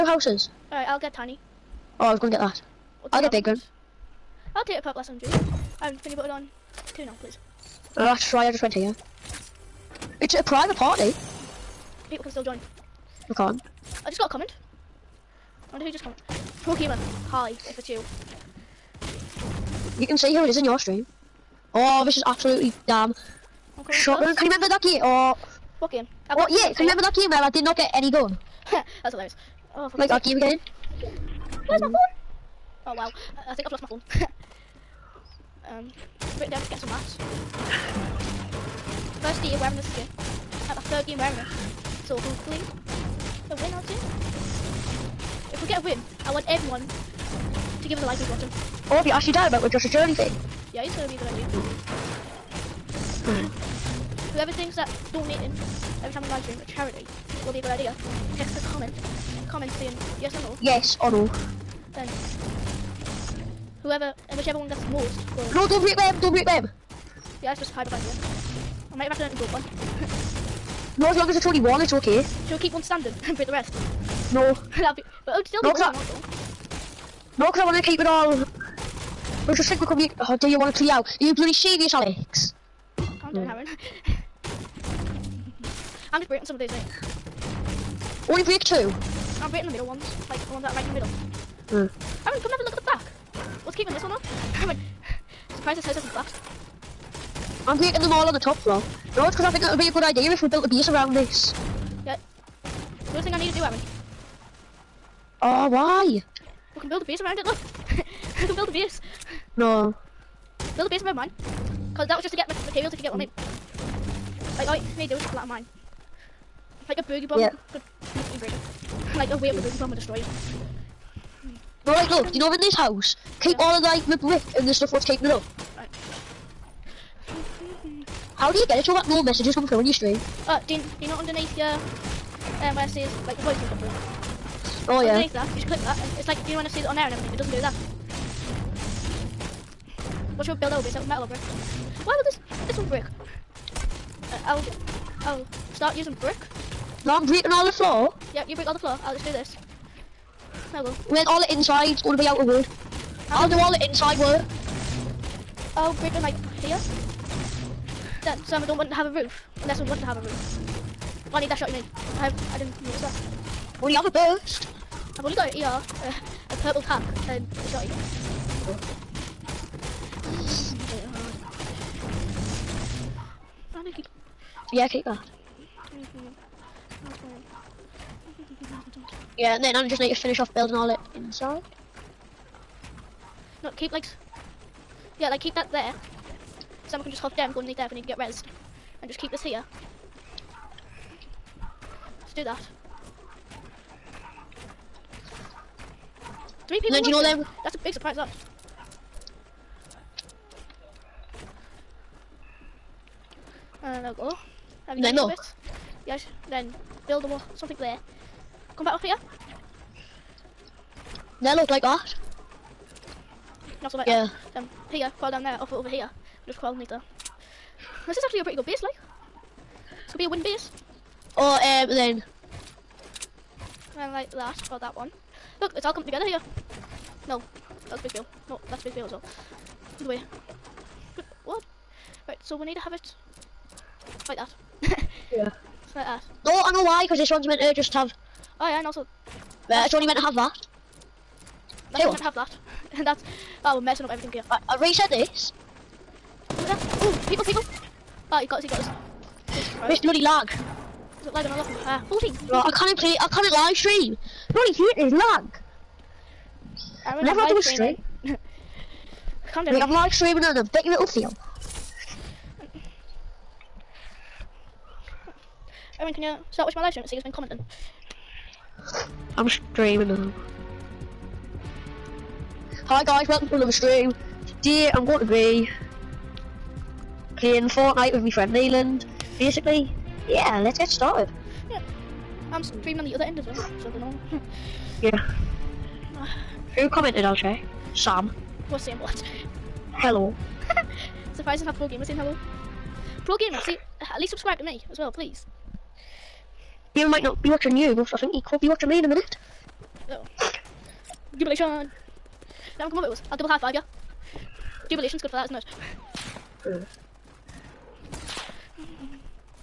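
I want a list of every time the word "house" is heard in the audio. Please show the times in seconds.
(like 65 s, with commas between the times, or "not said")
0 s, 95 s, 122 s.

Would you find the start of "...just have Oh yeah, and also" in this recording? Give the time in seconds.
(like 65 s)
237 s.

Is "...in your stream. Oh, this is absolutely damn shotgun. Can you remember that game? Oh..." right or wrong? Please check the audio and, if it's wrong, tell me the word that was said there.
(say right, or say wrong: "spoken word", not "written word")
right.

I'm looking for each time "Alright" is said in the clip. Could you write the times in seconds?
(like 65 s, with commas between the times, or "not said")
0 s, 121 s.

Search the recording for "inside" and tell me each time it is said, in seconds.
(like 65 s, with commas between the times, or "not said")
153 s, 181 s.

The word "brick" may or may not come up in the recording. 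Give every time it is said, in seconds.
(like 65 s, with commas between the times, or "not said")
124 s, 141 s, 146 s.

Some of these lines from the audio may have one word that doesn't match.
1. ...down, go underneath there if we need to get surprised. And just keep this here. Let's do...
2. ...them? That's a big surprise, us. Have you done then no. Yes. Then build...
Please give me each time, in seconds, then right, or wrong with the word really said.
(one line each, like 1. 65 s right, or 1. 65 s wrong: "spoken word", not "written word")
1. 187 s wrong: "resed", not "surprised"
2. 197 s right.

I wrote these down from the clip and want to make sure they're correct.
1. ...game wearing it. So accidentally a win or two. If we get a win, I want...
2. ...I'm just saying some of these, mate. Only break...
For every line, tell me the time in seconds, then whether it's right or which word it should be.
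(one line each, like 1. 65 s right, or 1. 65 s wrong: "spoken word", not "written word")
1. 41 s wrong: "hopefully", not "accidentally"
2. 86 s wrong: "breaking", not "saying".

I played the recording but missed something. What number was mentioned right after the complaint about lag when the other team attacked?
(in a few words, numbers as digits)
14.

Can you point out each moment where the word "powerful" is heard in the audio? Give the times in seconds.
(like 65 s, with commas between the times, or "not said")
not said.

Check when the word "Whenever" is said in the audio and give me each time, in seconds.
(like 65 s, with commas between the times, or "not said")
257 s.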